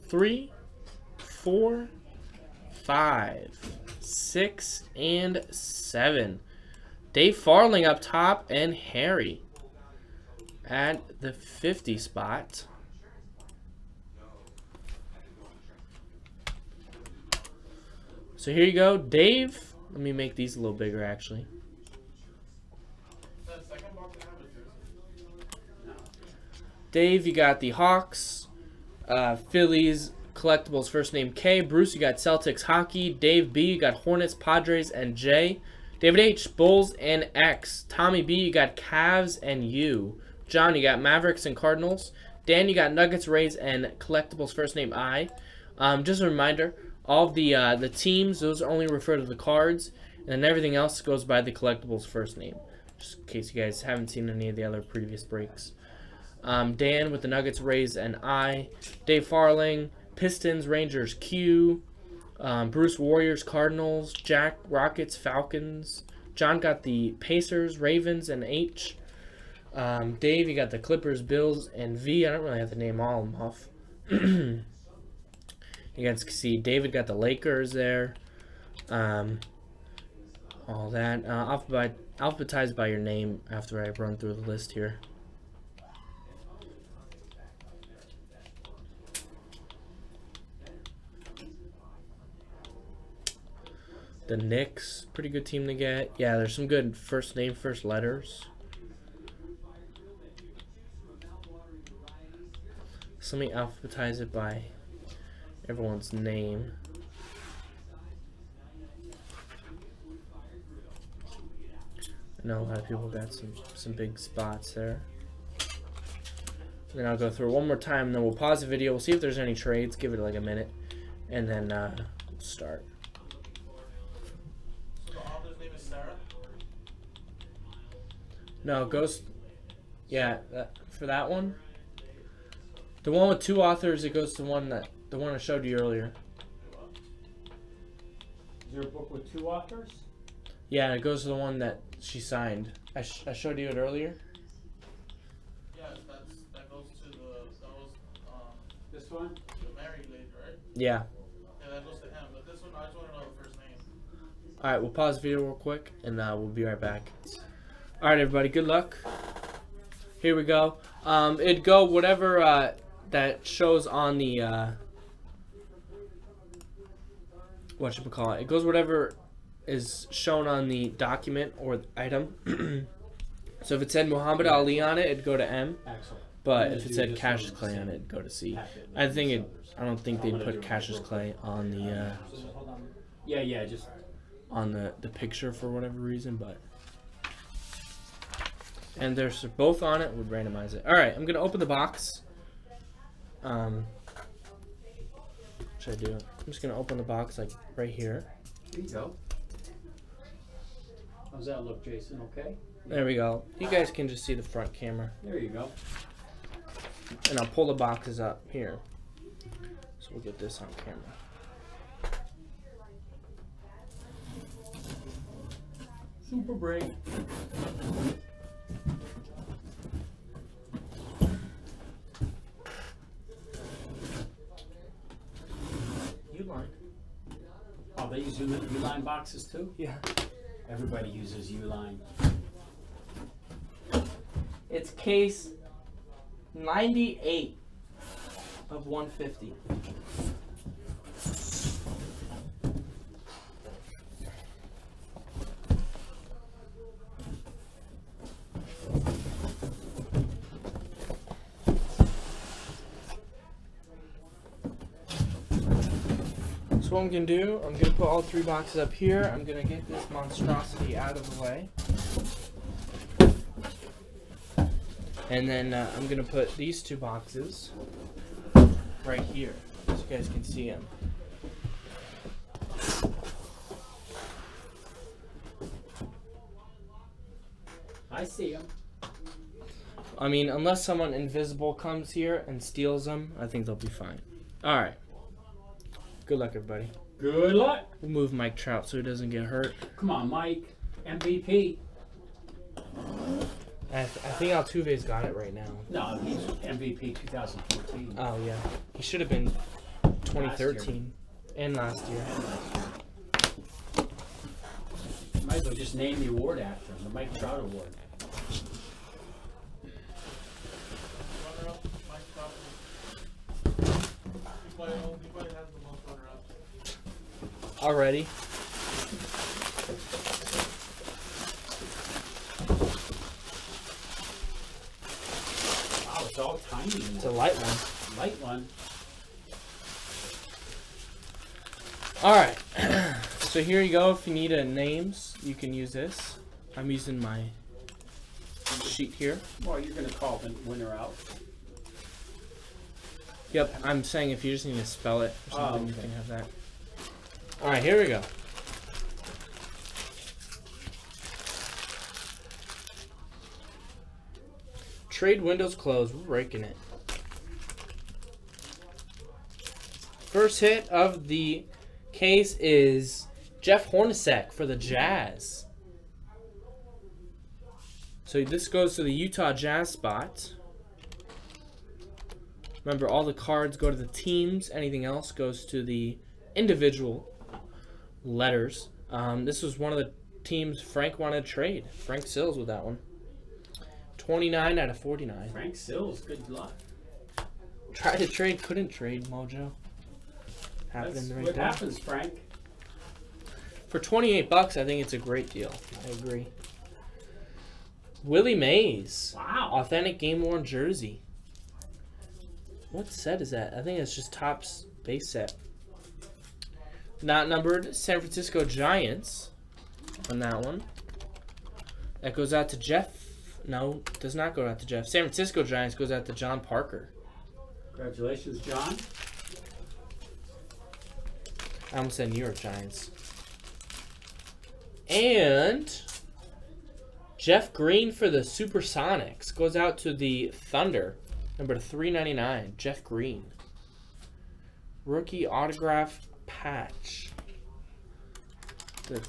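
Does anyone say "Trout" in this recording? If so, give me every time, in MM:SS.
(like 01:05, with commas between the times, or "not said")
04:48, 05:07.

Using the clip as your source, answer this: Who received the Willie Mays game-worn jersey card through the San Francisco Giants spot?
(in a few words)
John Parker.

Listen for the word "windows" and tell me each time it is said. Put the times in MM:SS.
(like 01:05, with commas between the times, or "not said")
05:55.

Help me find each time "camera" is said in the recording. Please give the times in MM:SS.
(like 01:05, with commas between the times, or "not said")
03:24, 03:30.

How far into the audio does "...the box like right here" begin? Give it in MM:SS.
03:16.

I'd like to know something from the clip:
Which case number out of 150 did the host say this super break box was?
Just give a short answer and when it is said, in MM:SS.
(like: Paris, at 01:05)
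98, at 03:56.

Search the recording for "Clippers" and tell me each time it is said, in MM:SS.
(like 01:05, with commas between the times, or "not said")
01:10.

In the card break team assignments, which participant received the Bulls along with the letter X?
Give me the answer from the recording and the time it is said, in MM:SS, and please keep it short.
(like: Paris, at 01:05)
David H, at 00:35.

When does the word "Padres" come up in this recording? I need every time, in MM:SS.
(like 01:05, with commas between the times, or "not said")
00:34.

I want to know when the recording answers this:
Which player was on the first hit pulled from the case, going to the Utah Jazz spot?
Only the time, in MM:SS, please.
06:03.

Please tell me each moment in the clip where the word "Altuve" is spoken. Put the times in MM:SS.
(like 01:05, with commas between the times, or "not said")
04:54.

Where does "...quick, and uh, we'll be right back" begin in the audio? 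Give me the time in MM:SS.
02:35.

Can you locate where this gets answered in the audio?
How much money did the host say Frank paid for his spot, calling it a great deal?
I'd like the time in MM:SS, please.
06:33.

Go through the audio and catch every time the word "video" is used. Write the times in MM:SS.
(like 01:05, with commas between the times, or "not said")
01:58, 02:35.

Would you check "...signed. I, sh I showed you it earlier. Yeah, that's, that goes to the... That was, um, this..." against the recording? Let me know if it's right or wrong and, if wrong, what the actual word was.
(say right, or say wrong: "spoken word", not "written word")
right.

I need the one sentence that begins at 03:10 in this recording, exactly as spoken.
All right, I'm gonna open the box.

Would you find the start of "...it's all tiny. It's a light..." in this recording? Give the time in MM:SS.
05:26.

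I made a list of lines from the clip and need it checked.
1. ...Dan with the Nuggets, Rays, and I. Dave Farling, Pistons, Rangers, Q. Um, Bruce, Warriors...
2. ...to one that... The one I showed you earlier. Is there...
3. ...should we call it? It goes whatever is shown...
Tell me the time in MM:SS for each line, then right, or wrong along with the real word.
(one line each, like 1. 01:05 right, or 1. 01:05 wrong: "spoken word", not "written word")
1. 00:56 right
2. 02:14 right
3. 02:47 right.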